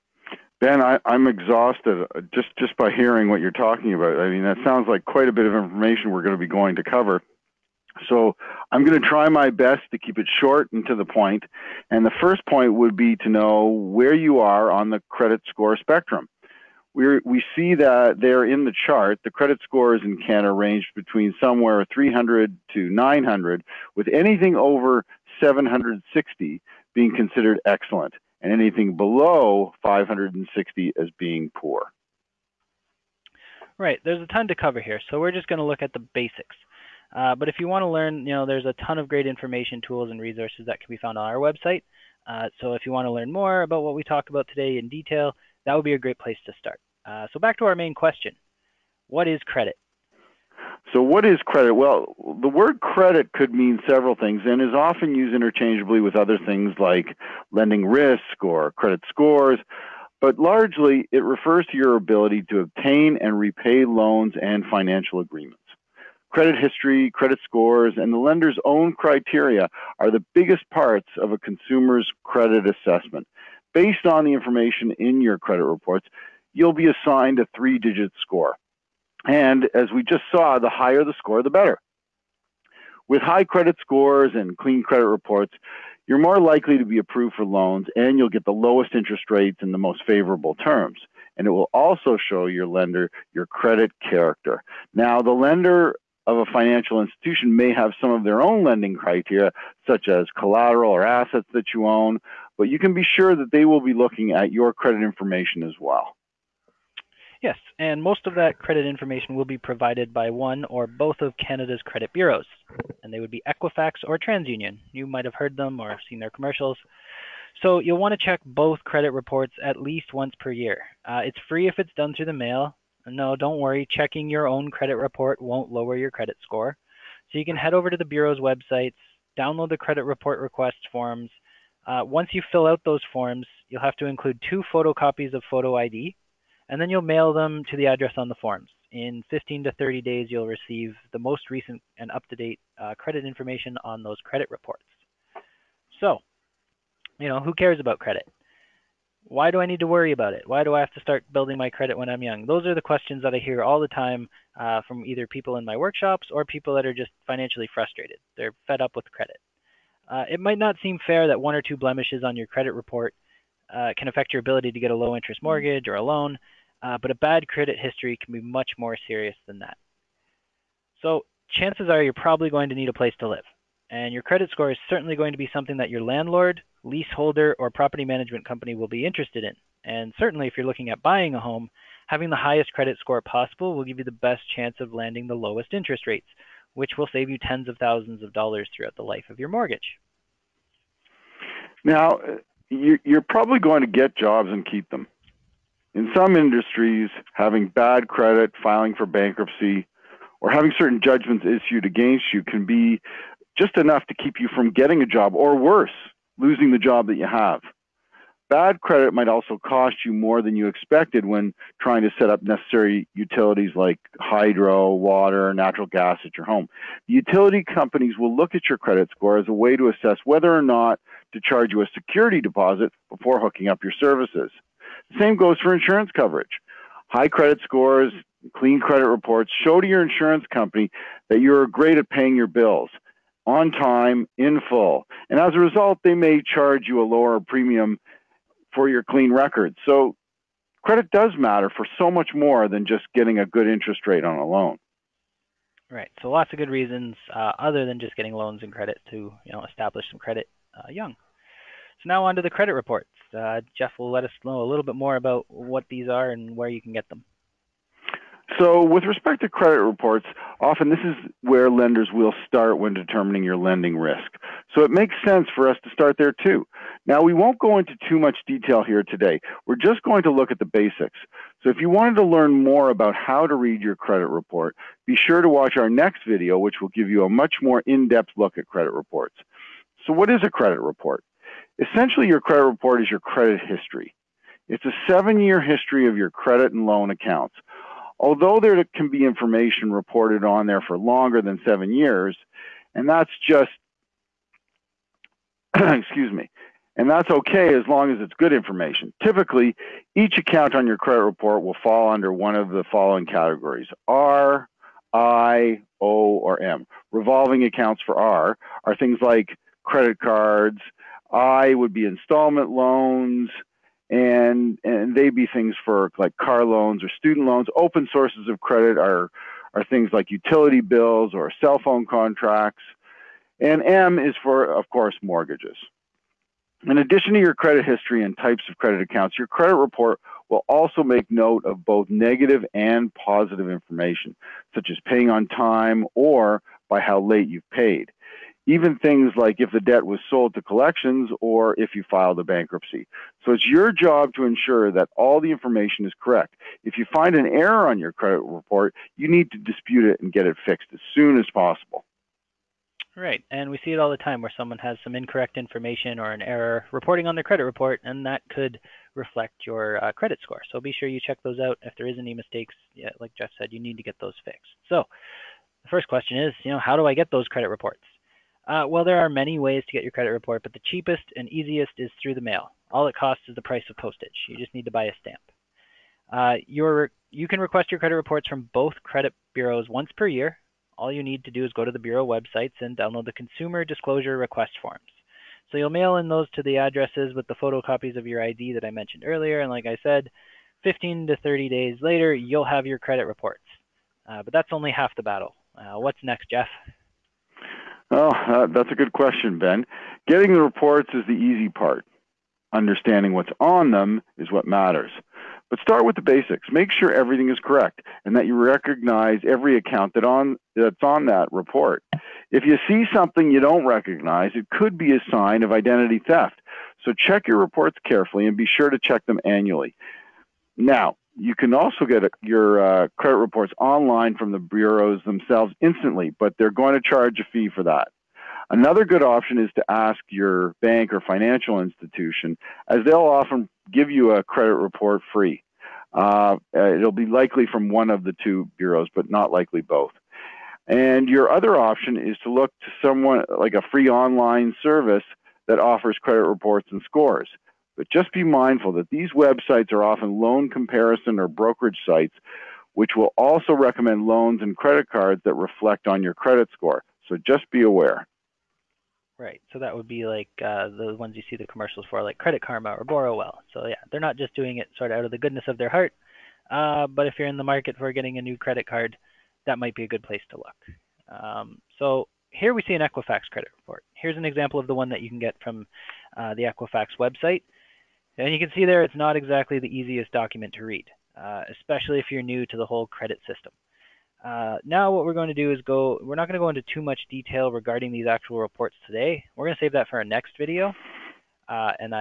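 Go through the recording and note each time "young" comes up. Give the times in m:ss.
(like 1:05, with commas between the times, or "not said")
2:32, 4:10.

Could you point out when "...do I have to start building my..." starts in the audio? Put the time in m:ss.
2:30.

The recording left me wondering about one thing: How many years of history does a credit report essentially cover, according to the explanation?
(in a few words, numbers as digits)
7.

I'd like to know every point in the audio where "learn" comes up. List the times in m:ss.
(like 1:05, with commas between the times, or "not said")
0:37, 0:43, 4:32.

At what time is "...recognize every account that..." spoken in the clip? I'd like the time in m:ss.
6:48.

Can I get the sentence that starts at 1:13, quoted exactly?
Based on the information in your credit reports, you'll be assigned a three digit score.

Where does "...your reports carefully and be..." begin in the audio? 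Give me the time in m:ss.
6:57.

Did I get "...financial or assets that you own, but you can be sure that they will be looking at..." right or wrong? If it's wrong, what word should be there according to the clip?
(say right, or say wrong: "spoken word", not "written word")
wrong: "collateral", not "financial".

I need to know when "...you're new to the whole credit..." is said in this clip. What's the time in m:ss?
8:02.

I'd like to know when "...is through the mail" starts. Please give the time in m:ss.
6:11.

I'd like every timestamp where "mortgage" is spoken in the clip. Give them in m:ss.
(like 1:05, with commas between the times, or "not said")
2:45, 3:09, 5:25.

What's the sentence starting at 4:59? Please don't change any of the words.
Typically, each account on your credit report will fall under one of the following categories R, I, O, or M.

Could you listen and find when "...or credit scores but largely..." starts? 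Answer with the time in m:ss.
0:58.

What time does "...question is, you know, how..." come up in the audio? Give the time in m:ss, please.
6:06.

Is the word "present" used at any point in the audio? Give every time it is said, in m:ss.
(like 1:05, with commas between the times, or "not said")
not said.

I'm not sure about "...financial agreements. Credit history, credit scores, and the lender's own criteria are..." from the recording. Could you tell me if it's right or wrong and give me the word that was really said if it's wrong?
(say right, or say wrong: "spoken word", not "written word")
right.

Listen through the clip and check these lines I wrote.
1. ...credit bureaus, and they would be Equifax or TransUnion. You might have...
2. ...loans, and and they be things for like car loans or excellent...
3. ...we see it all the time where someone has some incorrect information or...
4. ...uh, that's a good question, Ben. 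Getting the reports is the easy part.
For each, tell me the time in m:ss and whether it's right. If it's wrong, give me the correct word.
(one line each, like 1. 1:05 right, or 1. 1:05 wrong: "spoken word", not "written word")
1. 1:51 right
2. 5:12 wrong: "student", not "excellent"
3. 5:53 right
4. 6:38 right.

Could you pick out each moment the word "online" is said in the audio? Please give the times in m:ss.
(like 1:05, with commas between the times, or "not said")
7:03, 7:24.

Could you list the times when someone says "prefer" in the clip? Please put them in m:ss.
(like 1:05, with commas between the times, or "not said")
not said.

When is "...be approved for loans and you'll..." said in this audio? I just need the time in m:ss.
1:26.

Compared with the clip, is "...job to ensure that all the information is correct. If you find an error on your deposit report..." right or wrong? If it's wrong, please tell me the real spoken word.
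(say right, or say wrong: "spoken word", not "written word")
wrong: "credit", not "deposit".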